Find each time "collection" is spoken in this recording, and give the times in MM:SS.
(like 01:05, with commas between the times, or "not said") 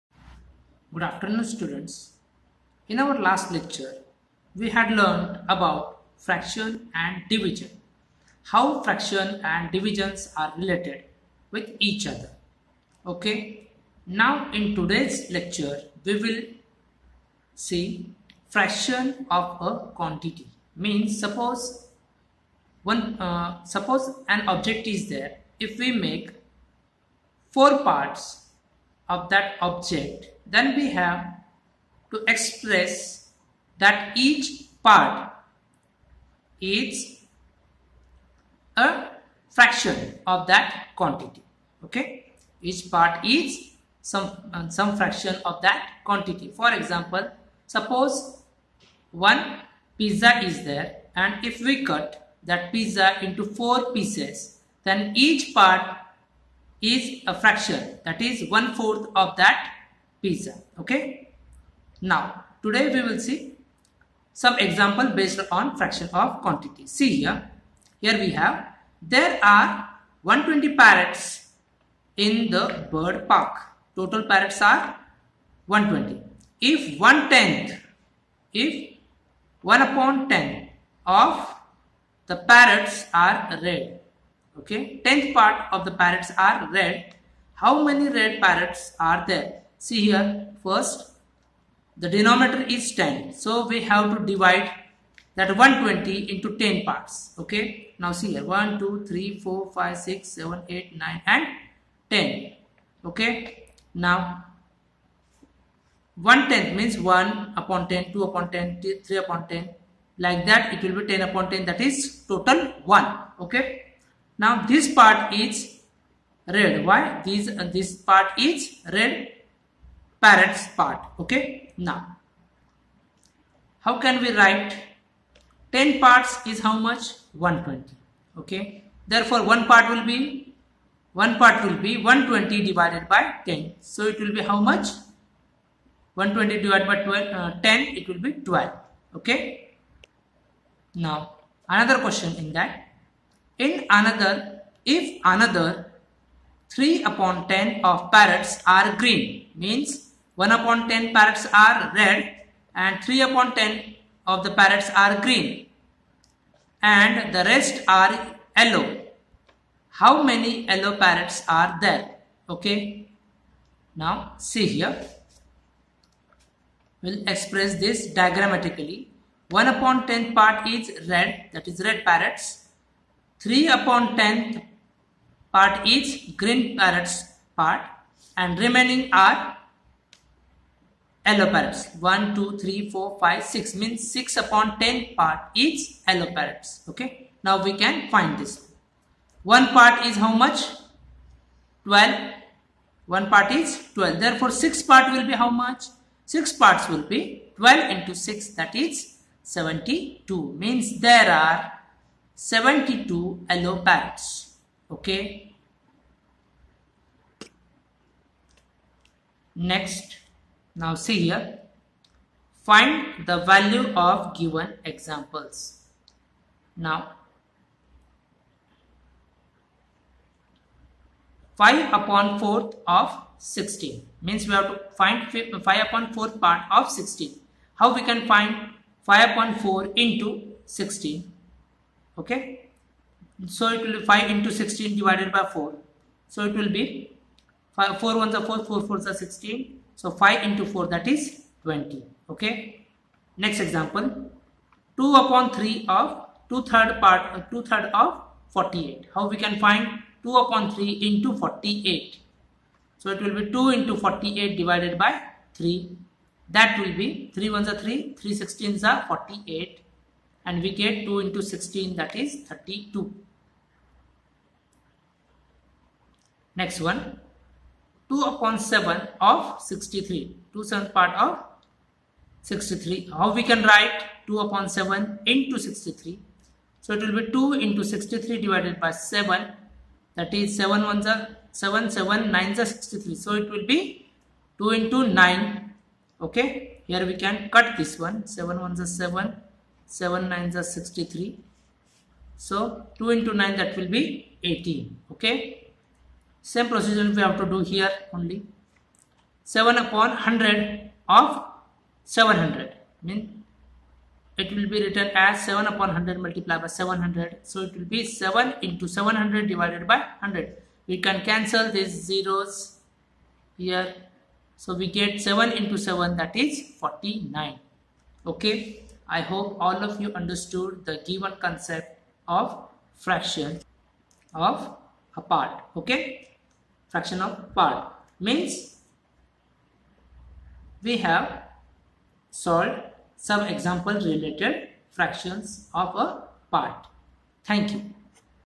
not said.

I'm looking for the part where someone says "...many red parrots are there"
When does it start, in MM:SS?
01:27.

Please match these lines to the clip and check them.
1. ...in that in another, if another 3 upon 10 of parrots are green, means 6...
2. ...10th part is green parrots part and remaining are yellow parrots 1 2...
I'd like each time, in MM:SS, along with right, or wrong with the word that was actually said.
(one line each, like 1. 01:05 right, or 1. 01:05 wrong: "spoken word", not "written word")
1. 02:22 wrong: "1", not "6"
2. 02:54 right.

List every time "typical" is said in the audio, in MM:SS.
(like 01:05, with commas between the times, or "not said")
not said.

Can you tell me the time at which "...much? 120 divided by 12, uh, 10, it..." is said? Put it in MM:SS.
02:14.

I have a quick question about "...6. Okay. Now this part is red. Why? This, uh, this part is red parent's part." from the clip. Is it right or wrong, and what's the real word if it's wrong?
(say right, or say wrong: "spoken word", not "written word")
wrong: "1", not "6".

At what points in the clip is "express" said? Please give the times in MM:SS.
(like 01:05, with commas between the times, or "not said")
00:32, 02:47.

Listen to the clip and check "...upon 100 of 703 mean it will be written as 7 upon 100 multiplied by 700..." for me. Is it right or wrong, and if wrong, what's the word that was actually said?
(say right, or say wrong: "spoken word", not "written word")
wrong: "700", not "703".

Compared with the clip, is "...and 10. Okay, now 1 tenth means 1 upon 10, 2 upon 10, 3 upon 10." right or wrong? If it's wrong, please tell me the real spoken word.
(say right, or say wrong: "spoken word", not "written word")
right.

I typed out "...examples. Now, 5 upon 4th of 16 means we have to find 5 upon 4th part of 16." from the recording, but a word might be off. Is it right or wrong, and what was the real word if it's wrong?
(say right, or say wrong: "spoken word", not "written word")
right.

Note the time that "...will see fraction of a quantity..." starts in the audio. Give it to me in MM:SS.
00:16.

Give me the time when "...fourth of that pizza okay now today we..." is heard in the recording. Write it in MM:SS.
00:58.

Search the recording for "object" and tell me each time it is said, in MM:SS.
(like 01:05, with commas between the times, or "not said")
00:24, 00:29.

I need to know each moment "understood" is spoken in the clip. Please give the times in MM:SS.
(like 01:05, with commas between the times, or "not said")
05:20.